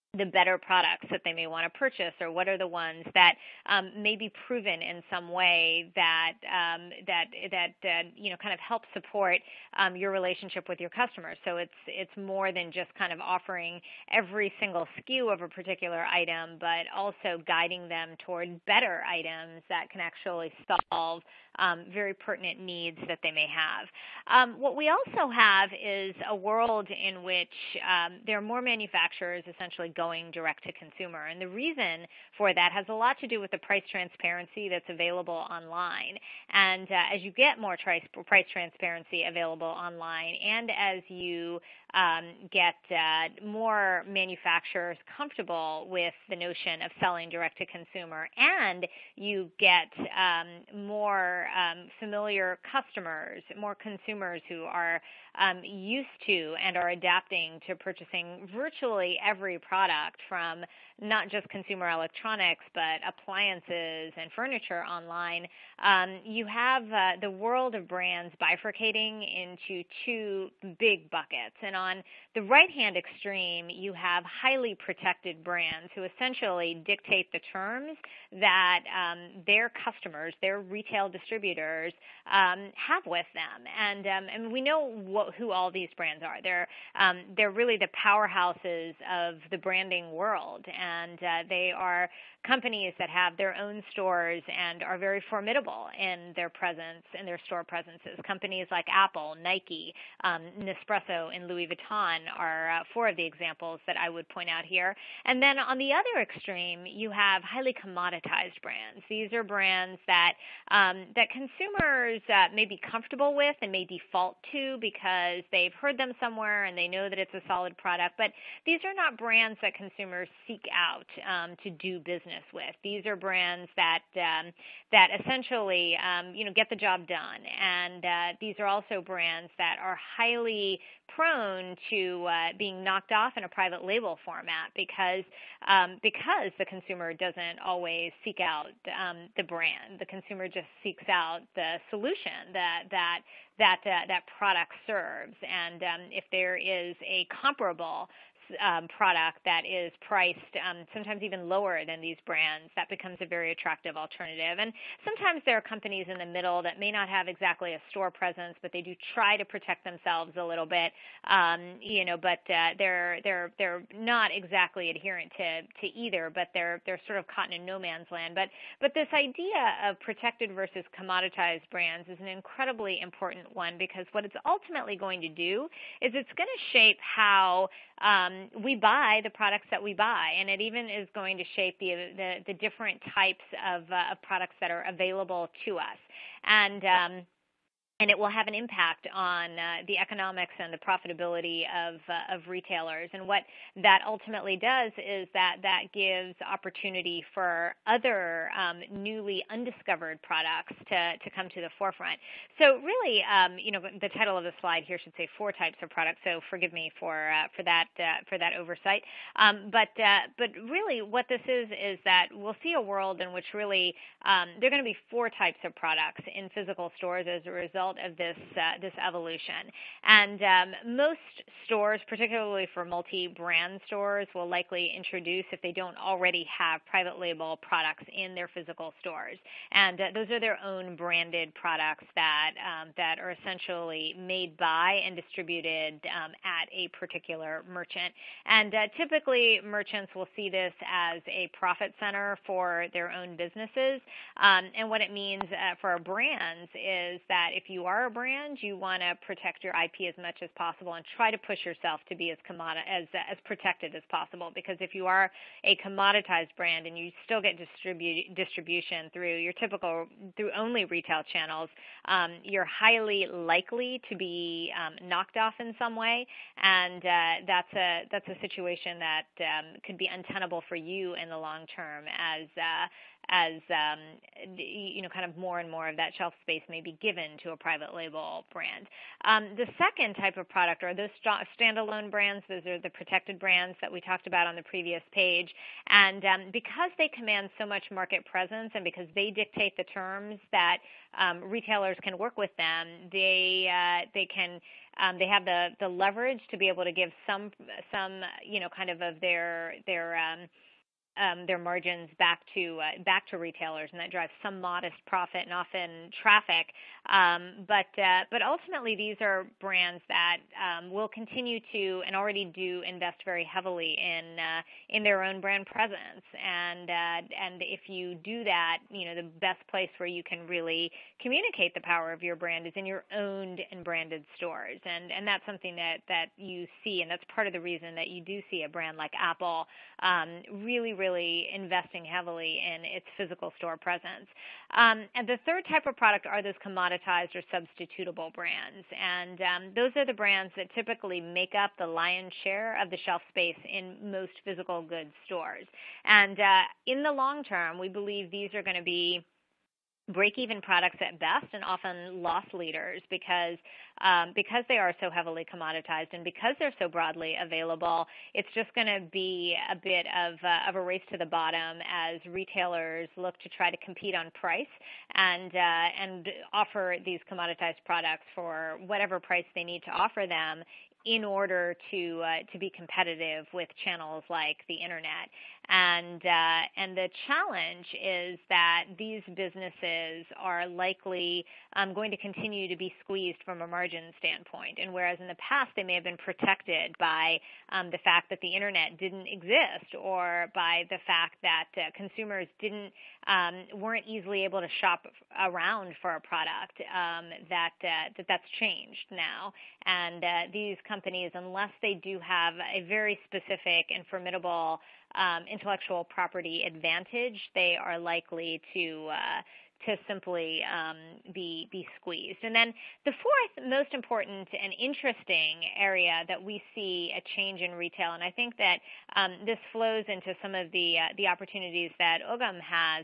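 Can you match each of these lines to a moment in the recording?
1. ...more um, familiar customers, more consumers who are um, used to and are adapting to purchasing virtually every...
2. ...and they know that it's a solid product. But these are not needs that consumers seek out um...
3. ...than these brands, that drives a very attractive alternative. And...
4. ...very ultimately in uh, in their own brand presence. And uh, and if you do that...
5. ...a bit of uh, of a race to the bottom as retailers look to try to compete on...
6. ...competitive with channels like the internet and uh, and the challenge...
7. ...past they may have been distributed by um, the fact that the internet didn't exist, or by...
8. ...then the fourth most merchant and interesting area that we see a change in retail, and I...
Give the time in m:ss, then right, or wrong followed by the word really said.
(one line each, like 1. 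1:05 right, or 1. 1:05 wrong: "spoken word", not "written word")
1. 0:50 right
2. 1:56 wrong: "brands", not "needs"
3. 2:31 wrong: "becomes", not "drives"
4. 5:13 wrong: "heavily", not "ultimately"
5. 5:59 right
6. 6:12 right
7. 6:25 wrong: "protected", not "distributed"
8. 6:52 wrong: "important", not "merchant".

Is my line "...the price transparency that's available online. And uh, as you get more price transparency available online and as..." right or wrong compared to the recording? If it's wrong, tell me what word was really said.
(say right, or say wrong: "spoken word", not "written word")
right.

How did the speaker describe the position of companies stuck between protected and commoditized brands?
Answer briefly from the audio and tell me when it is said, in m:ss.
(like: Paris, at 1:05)
No man's land, at 2:47.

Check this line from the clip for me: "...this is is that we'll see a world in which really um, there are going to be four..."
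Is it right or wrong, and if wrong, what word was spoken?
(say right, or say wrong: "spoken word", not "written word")
right.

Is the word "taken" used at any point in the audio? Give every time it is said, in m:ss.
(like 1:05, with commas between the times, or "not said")
not said.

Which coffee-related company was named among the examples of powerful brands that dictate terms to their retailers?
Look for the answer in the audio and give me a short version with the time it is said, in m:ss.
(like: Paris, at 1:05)
Nespresso, at 1:40.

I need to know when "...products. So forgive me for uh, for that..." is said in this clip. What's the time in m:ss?
3:25.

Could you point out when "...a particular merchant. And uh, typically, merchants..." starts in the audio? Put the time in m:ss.
3:56.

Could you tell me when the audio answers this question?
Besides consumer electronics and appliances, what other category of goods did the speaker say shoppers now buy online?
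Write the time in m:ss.
1:04.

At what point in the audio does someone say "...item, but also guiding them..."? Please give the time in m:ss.
0:16.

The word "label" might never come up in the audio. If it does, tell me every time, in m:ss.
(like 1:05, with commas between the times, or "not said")
2:13, 3:47, 4:37.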